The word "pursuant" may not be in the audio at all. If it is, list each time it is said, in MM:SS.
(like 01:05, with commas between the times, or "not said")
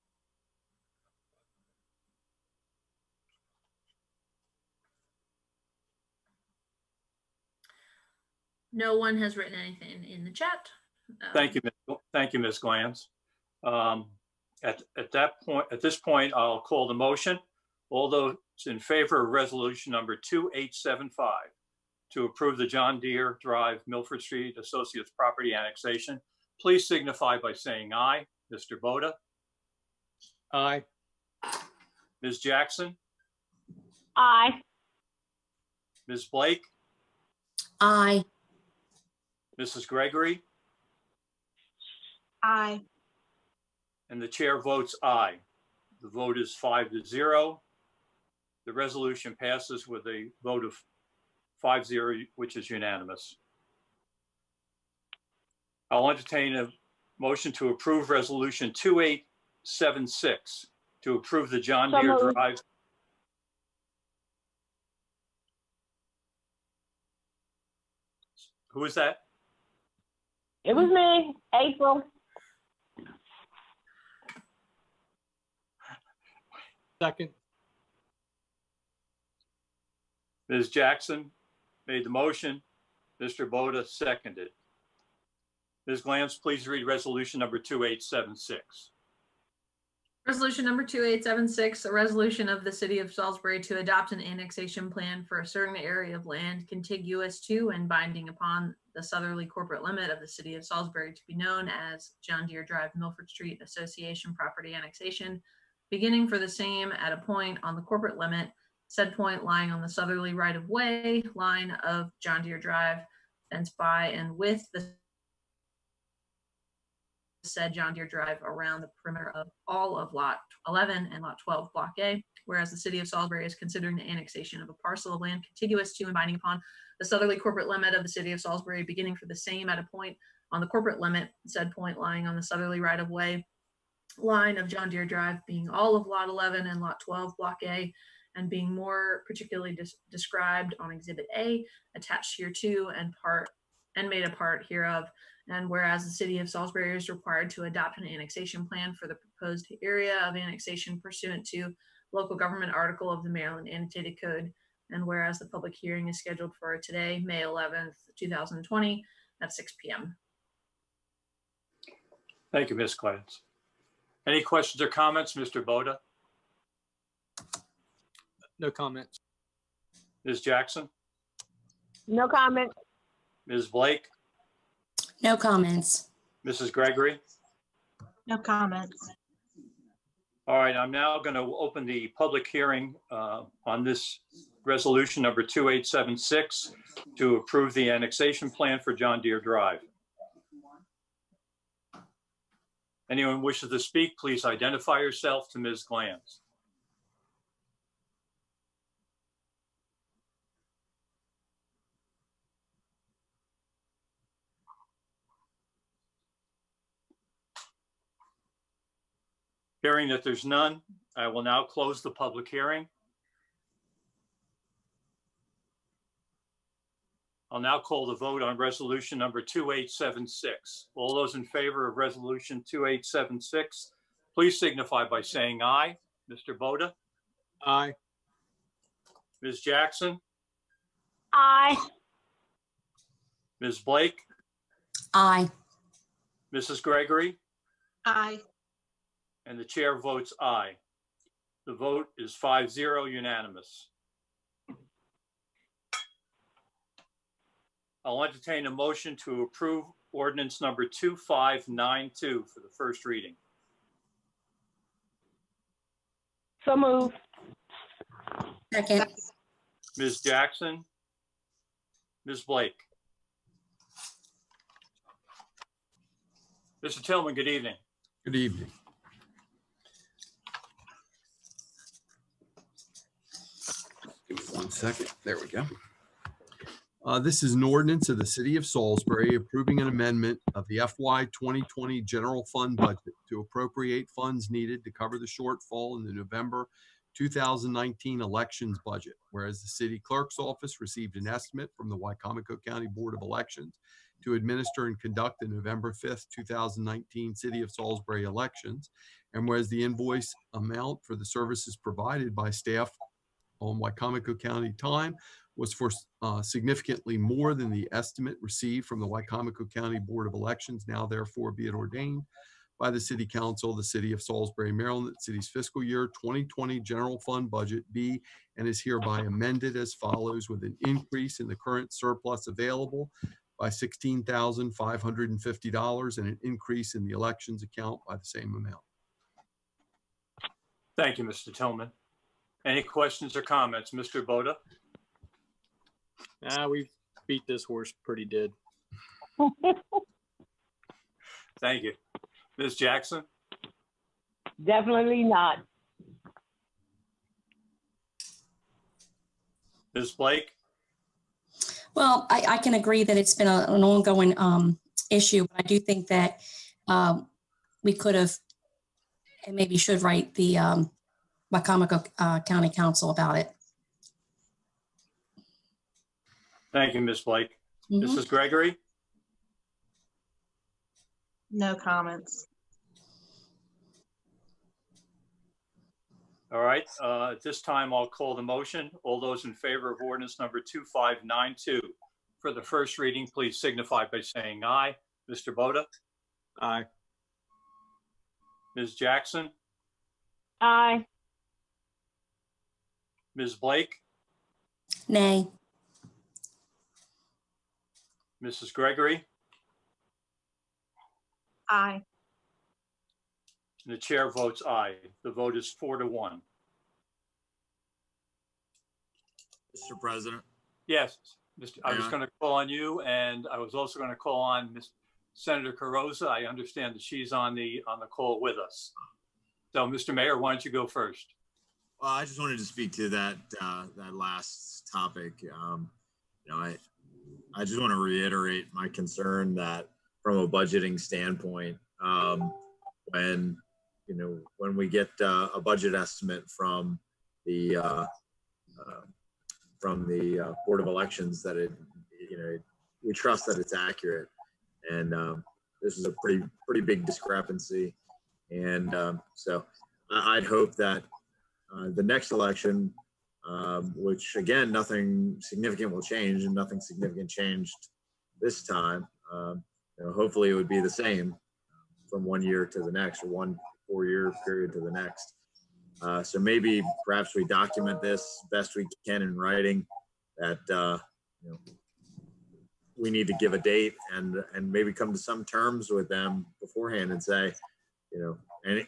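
02:31.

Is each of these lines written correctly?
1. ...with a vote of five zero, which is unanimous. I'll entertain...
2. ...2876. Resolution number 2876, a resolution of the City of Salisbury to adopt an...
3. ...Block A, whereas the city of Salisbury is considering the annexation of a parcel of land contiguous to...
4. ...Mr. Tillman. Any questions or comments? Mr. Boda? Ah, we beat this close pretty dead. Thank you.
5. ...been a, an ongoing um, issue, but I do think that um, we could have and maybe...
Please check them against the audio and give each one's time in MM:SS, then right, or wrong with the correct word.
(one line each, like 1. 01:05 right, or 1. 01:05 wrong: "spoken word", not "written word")
1. 00:49 right
2. 01:27 right
3. 02:01 right
4. 05:31 wrong: "horse", not "close"
5. 05:53 right.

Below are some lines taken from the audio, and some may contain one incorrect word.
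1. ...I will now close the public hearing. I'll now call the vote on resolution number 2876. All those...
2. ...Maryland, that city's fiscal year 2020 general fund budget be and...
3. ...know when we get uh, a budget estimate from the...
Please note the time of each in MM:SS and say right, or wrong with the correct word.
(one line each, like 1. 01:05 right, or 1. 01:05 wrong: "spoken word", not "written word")
1. 03:31 right
2. 05:14 right
3. 07:14 right.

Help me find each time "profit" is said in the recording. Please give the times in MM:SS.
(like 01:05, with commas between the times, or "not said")
not said.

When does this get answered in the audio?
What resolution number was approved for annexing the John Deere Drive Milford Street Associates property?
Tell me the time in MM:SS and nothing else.
00:20.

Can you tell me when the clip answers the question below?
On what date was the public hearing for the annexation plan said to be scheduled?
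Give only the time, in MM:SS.
02:37.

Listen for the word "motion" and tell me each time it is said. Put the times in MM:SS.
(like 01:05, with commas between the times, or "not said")
00:16, 00:57, 01:22, 04:08, 06:18.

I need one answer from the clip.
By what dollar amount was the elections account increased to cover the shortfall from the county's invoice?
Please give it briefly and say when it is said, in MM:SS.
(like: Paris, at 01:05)
$16,550, at 05:23.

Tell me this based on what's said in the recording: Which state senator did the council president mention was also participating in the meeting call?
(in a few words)
Carozza.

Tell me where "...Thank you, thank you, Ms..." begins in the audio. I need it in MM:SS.
00:11.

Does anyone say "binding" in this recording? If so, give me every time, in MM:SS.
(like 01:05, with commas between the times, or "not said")
01:37, 02:06.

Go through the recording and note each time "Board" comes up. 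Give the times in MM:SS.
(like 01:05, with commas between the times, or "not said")
04:52, 05:09, 07:20.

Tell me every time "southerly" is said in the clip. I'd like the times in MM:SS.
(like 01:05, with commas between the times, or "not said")
01:39, 01:49, 02:07, 02:12.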